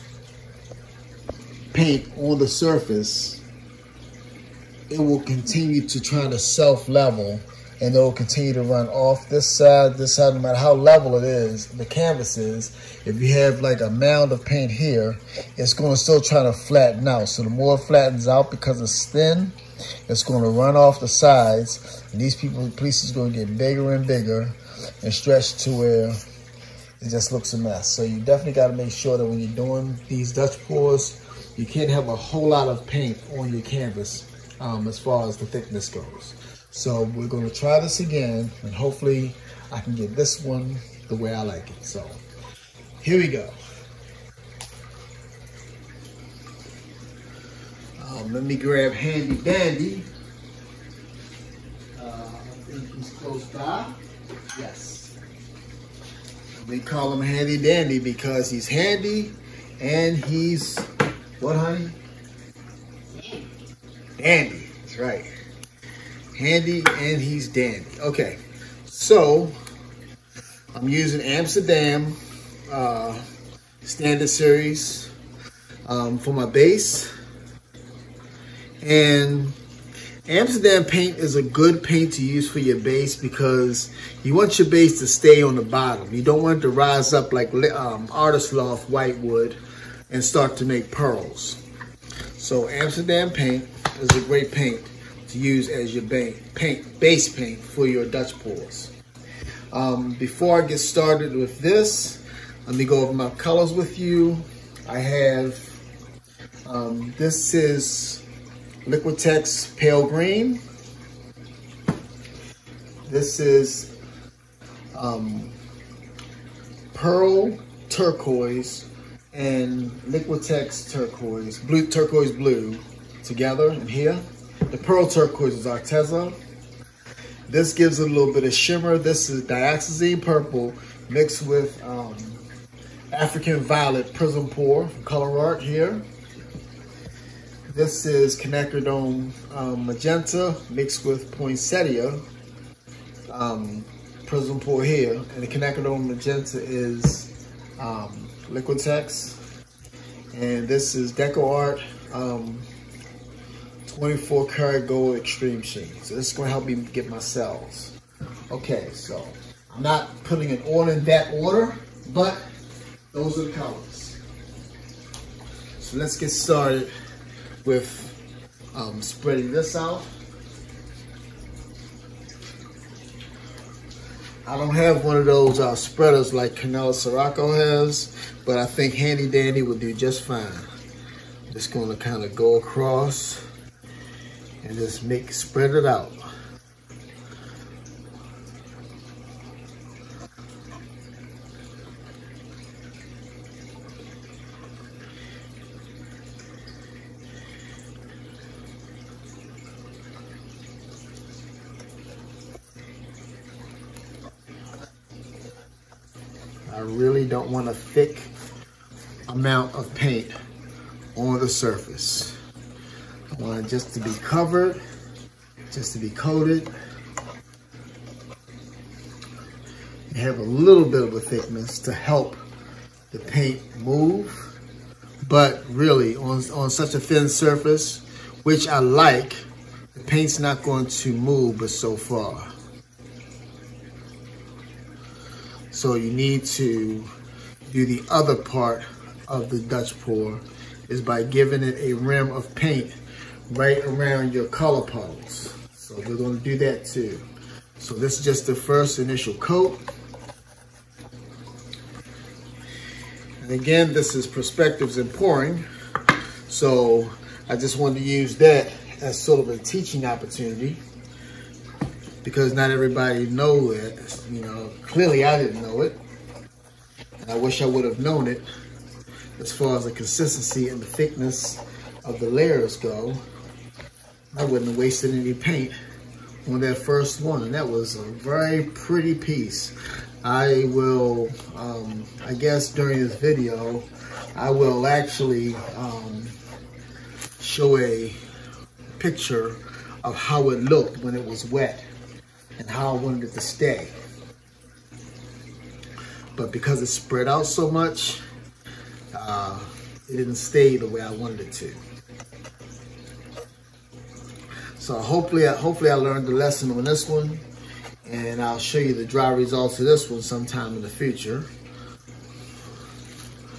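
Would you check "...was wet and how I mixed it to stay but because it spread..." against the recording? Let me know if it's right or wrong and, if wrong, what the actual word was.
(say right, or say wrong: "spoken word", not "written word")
wrong: "wanted", not "mixed".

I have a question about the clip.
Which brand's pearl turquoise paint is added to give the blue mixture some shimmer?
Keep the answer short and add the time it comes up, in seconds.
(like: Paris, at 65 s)
Arteza, at 125 s.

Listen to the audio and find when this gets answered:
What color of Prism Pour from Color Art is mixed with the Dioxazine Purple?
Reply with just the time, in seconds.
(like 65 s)
133 s.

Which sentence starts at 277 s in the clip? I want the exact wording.
And that was a very pretty piece.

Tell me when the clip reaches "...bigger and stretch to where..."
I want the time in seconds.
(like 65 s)
24 s.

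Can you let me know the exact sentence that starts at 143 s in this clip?
Um, prism pour here, and the Quinacridone magenta is um, Liquitex, and this is Deco Art um, 24 karat gold extreme sheen.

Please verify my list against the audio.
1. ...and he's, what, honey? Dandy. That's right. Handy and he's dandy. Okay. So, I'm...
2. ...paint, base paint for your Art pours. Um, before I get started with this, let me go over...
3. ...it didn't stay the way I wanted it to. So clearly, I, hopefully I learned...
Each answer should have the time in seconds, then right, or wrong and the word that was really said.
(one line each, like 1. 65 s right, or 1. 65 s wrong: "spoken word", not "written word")
1. 59 s right
2. 96 s wrong: "Dutch", not "Art"
3. 300 s wrong: "hopefully", not "clearly".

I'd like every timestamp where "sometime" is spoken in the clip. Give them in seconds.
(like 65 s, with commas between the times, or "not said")
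310 s.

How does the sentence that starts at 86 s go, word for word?
You don't want it to rise up like um, Artist Loft White wood, and start to make pearls.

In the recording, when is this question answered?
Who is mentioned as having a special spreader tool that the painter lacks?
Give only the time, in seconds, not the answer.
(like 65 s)
176 s.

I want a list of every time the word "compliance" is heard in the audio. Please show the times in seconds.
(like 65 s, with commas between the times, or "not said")
not said.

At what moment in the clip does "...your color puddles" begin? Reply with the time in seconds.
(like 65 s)
244 s.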